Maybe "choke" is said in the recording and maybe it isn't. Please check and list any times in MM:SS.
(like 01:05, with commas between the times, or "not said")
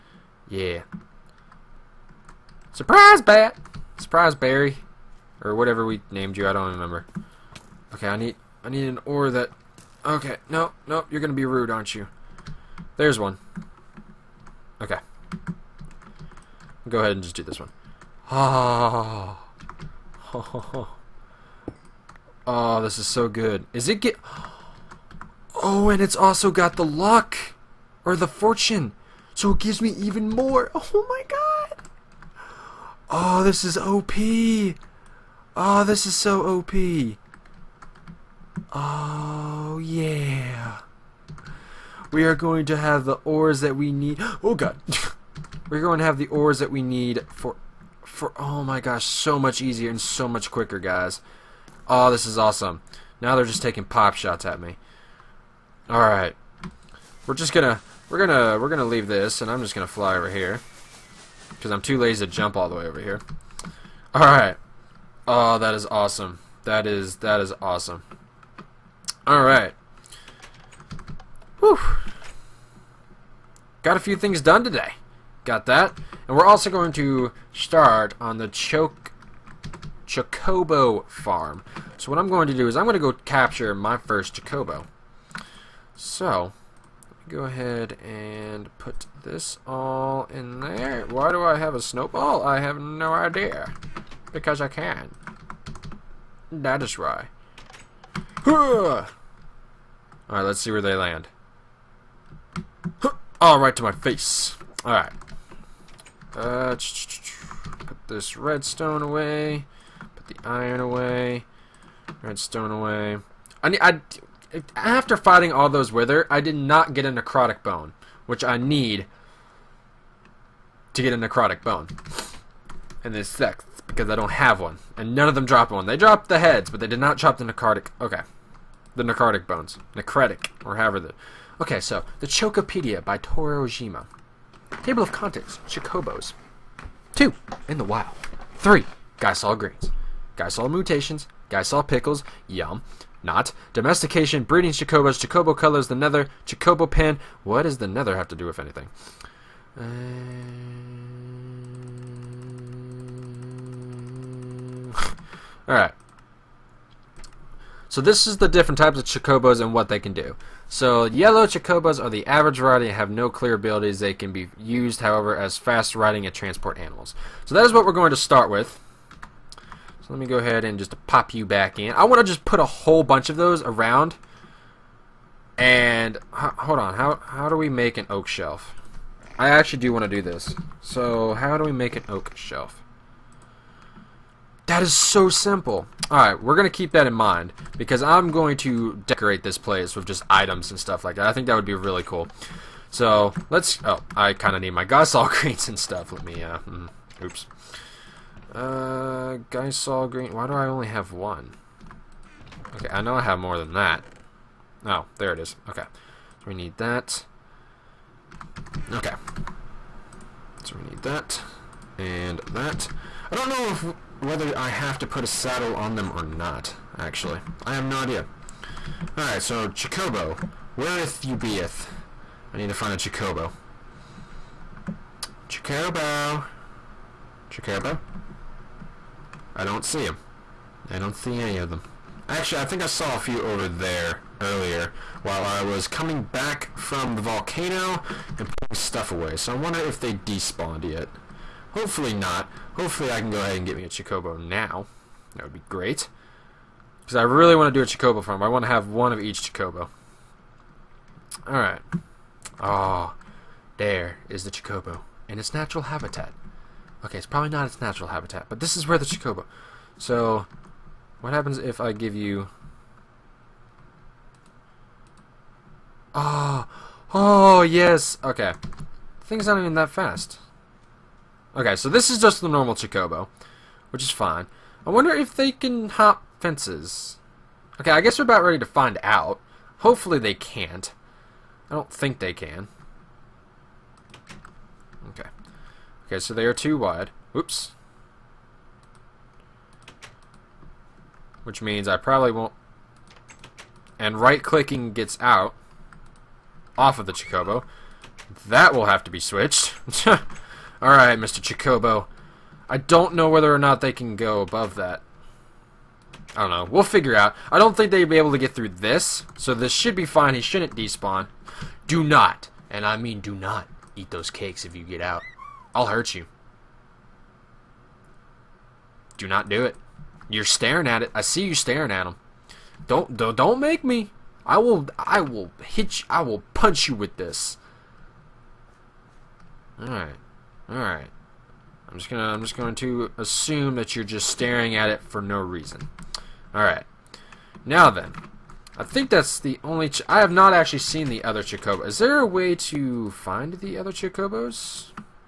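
01:18.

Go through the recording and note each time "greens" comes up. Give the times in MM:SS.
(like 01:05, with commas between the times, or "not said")
02:19, 03:15, 03:20.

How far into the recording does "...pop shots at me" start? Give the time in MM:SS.
00:53.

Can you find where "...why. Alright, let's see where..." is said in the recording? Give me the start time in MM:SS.
01:36.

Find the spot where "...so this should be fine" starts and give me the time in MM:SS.
05:09.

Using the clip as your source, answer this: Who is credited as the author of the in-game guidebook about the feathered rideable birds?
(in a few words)
Torojima.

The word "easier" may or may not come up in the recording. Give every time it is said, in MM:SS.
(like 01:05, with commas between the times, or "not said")
00:49.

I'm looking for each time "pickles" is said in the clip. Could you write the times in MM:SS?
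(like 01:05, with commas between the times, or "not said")
02:21.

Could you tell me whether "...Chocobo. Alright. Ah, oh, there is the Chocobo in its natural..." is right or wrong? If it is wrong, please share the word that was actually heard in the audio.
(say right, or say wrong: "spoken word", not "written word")
right.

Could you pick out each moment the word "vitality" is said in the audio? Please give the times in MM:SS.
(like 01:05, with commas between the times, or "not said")
not said.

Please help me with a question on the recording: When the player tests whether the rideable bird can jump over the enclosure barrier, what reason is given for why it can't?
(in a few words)
they are too wide.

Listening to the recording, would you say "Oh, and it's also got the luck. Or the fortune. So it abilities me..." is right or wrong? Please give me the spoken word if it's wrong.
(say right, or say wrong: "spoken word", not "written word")
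wrong: "gives", not "abilities".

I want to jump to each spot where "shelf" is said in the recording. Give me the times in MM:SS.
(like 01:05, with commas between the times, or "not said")
02:58, 03:02.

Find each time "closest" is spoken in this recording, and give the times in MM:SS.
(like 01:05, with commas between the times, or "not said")
not said.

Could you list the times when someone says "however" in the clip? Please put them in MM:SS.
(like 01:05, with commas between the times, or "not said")
02:10, 02:45.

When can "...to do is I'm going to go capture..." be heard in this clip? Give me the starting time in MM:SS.
01:22.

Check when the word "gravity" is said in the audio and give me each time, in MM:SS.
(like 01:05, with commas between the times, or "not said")
not said.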